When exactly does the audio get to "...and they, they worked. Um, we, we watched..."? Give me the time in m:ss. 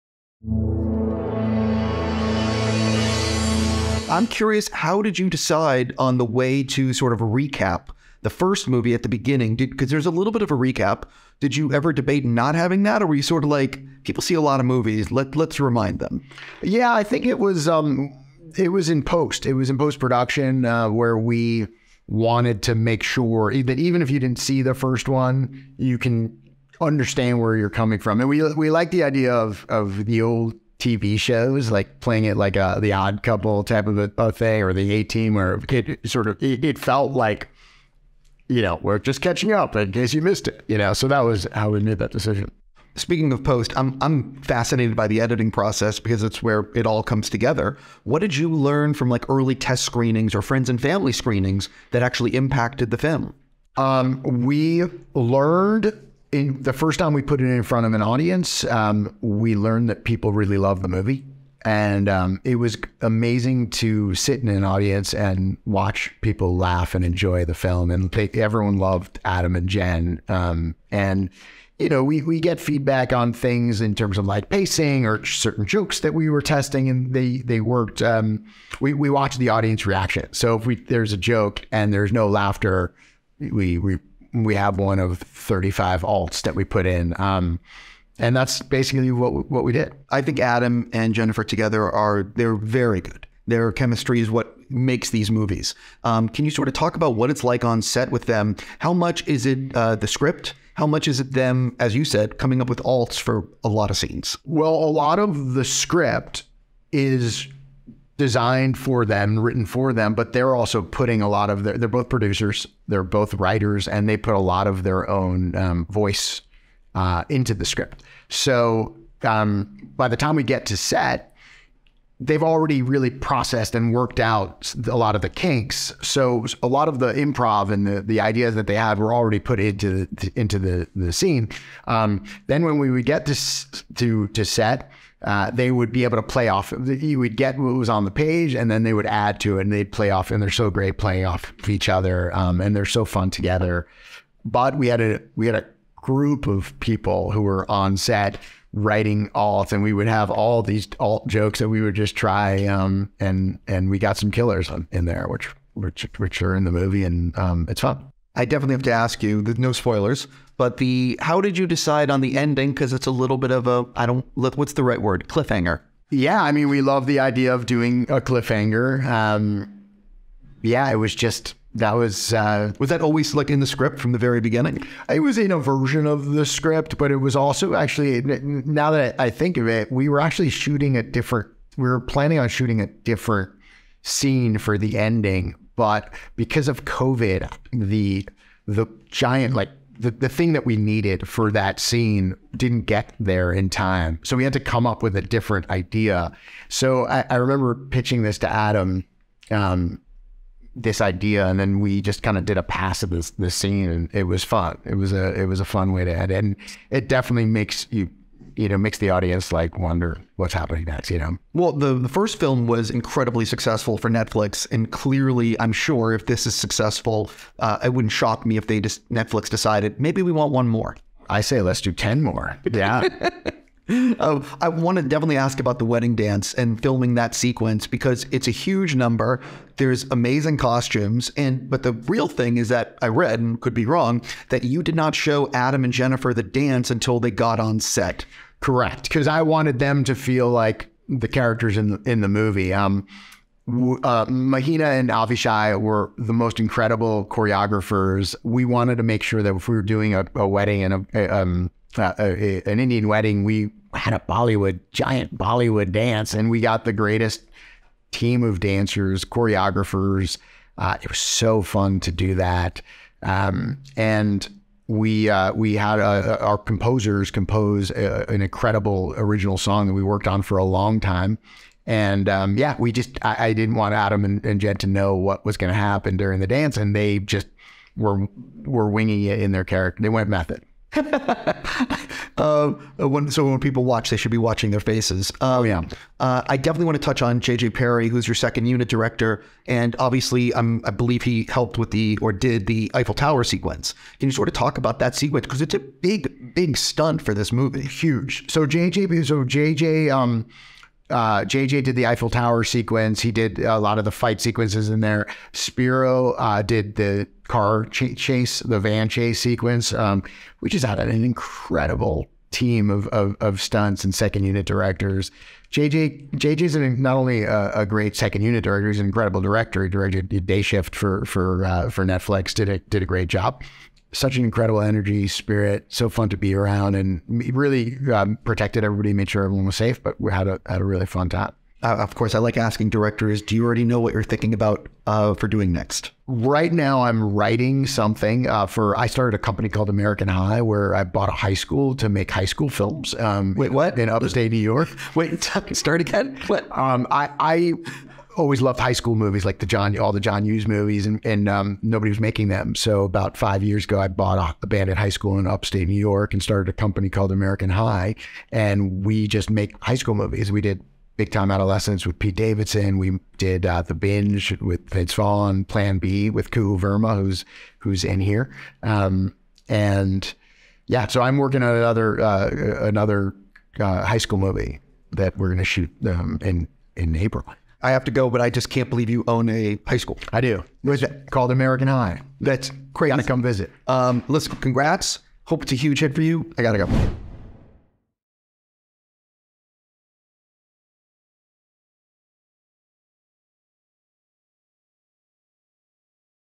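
1:16.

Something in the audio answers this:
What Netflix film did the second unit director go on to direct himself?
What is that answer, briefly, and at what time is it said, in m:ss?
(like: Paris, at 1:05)
Day Shift, at 5:20.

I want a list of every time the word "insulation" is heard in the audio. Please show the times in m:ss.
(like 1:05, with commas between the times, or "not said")
not said.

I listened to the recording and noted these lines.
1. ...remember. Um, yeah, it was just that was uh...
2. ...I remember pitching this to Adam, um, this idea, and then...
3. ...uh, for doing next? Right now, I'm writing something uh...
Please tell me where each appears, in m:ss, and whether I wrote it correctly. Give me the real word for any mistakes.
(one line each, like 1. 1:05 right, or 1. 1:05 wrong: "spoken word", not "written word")
1. 2:48 wrong: "cliffhanger", not "remember"
2. 3:17 right
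3. 5:35 right.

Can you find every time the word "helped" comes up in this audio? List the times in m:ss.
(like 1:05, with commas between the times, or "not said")
4:51.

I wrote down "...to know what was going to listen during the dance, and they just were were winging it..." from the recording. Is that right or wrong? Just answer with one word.
wrong.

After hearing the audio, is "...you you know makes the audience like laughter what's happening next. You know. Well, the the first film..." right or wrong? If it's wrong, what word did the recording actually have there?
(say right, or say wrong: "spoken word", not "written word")
wrong: "wonder", not "laughter".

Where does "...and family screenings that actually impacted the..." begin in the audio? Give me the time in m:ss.
0:50.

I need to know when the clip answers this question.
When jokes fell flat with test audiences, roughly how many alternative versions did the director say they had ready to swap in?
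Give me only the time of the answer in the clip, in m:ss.
1:25.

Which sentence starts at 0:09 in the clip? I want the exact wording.
Because there's a little bit of a recap.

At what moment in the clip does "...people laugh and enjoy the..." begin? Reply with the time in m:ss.
1:06.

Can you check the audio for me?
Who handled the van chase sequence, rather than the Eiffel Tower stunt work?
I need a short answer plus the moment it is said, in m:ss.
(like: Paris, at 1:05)
Spiro, at 5:05.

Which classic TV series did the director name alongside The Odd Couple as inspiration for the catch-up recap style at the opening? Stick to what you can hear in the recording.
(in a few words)
The A Team.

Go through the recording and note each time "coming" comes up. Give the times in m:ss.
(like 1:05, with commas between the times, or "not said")
0:27, 1:42.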